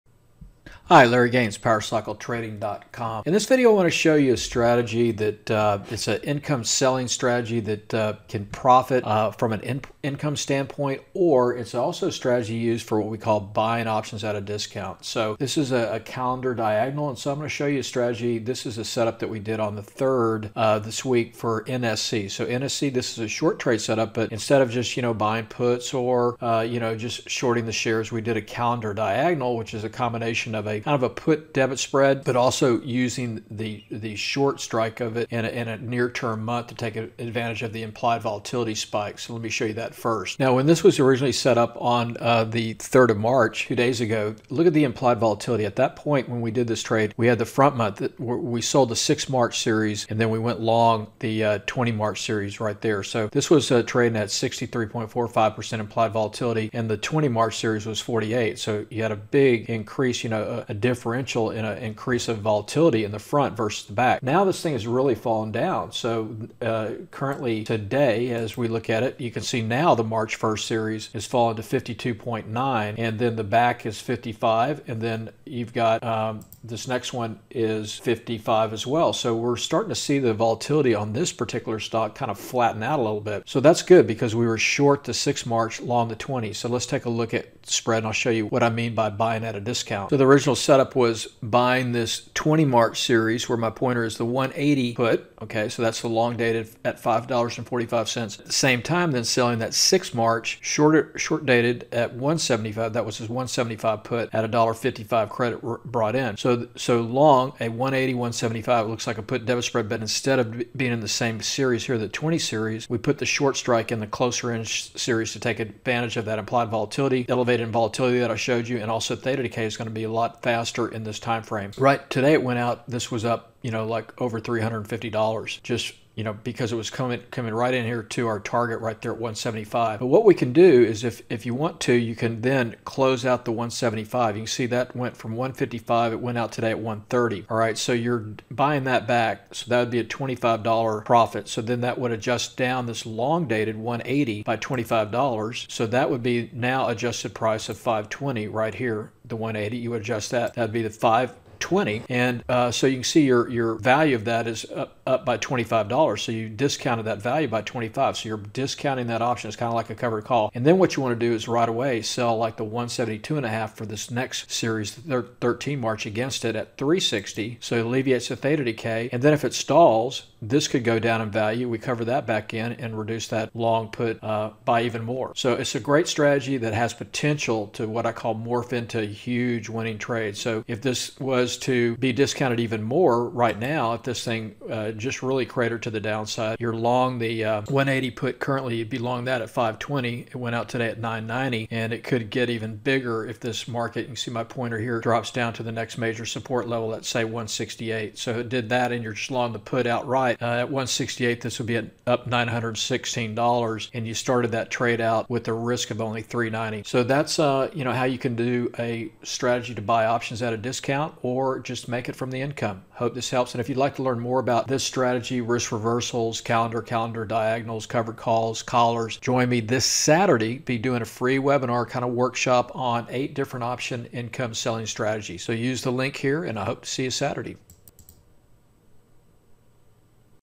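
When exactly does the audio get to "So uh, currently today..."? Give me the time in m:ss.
1:05.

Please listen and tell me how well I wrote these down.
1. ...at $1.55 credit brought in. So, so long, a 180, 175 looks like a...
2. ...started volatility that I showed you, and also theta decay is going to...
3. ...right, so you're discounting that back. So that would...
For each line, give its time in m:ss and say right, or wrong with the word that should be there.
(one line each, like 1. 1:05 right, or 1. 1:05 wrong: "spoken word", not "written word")
1. 1:44 right
2. 1:57 wrong: "elevated", not "started"
3. 2:17 wrong: "buying", not "discounting".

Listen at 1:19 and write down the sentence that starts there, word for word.
So we're starting to see the volatility on this particular stock kind of flatten out a little bit.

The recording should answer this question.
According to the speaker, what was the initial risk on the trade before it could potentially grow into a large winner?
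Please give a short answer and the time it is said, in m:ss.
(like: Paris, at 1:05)
390, at 3:26.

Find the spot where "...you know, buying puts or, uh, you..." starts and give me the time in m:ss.
0:24.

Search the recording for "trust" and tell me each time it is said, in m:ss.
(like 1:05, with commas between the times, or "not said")
not said.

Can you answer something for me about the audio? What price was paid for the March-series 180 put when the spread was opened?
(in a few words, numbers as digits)
$5.45.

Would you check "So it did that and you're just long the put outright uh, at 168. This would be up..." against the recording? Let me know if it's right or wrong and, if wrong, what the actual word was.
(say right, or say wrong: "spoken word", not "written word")
right.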